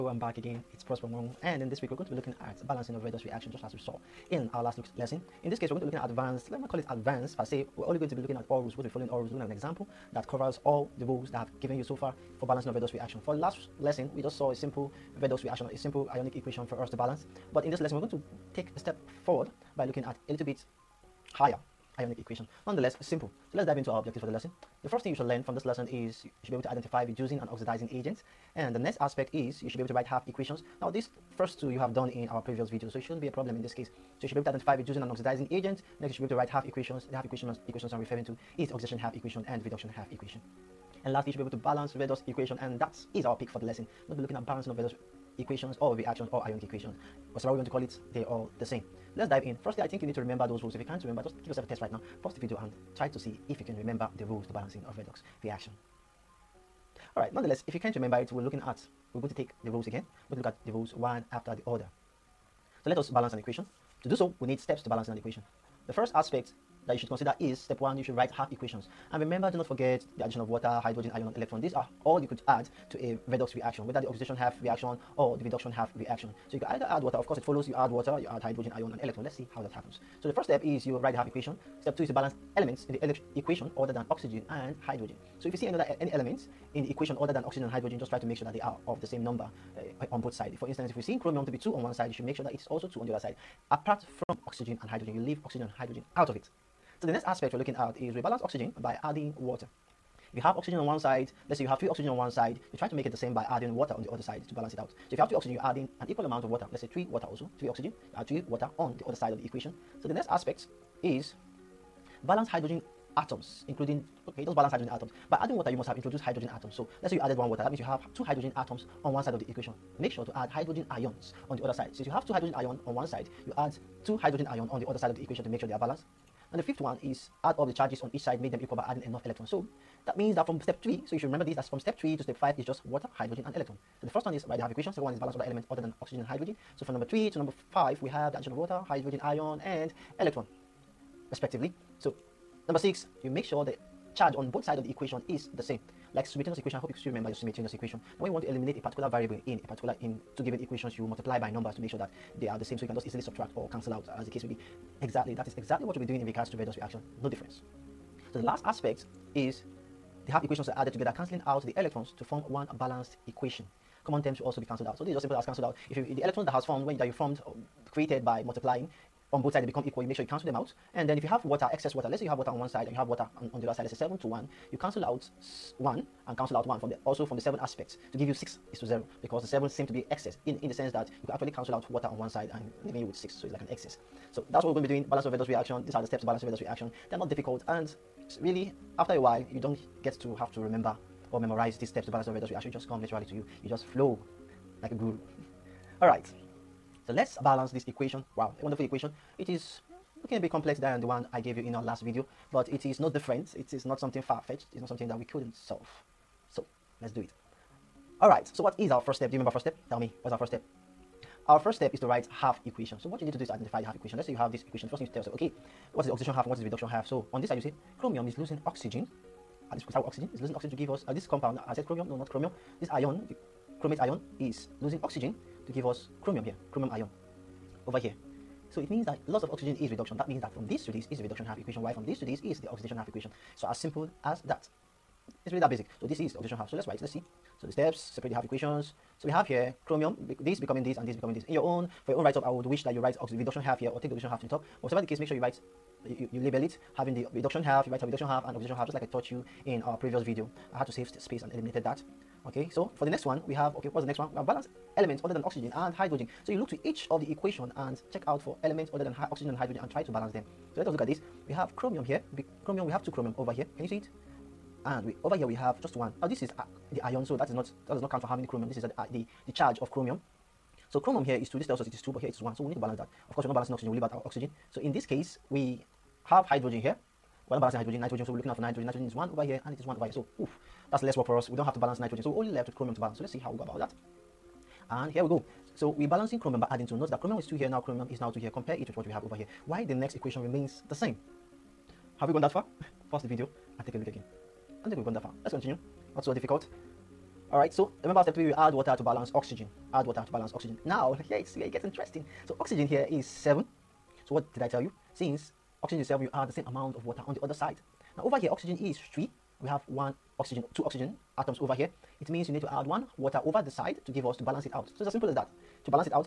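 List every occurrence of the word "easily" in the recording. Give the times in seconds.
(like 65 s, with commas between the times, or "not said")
153 s.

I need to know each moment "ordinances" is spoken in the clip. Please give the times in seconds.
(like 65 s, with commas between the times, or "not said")
not said.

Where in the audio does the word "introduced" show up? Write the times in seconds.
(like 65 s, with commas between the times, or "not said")
115 s.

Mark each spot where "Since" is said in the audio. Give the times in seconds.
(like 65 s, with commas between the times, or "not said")
121 s, 305 s.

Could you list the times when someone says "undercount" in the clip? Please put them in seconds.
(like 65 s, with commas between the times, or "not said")
not said.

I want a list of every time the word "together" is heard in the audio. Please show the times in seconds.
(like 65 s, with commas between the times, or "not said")
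160 s.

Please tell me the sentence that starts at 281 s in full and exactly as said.
We don't have to balance nitrogen.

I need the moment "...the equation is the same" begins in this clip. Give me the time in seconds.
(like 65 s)
144 s.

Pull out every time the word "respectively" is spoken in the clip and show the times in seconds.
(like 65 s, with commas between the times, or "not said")
141 s.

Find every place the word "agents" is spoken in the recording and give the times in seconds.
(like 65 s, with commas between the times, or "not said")
27 s, 35 s.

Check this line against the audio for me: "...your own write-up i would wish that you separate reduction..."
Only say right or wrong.
wrong.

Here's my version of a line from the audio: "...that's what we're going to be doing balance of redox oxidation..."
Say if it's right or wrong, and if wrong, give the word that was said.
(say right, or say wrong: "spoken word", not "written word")
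wrong: "reaction", not "oxidation".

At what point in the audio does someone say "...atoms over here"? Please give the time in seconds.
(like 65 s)
311 s.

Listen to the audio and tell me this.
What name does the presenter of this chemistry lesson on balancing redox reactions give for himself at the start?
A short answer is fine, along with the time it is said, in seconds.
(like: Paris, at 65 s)
Prosper Wong, at 0 s.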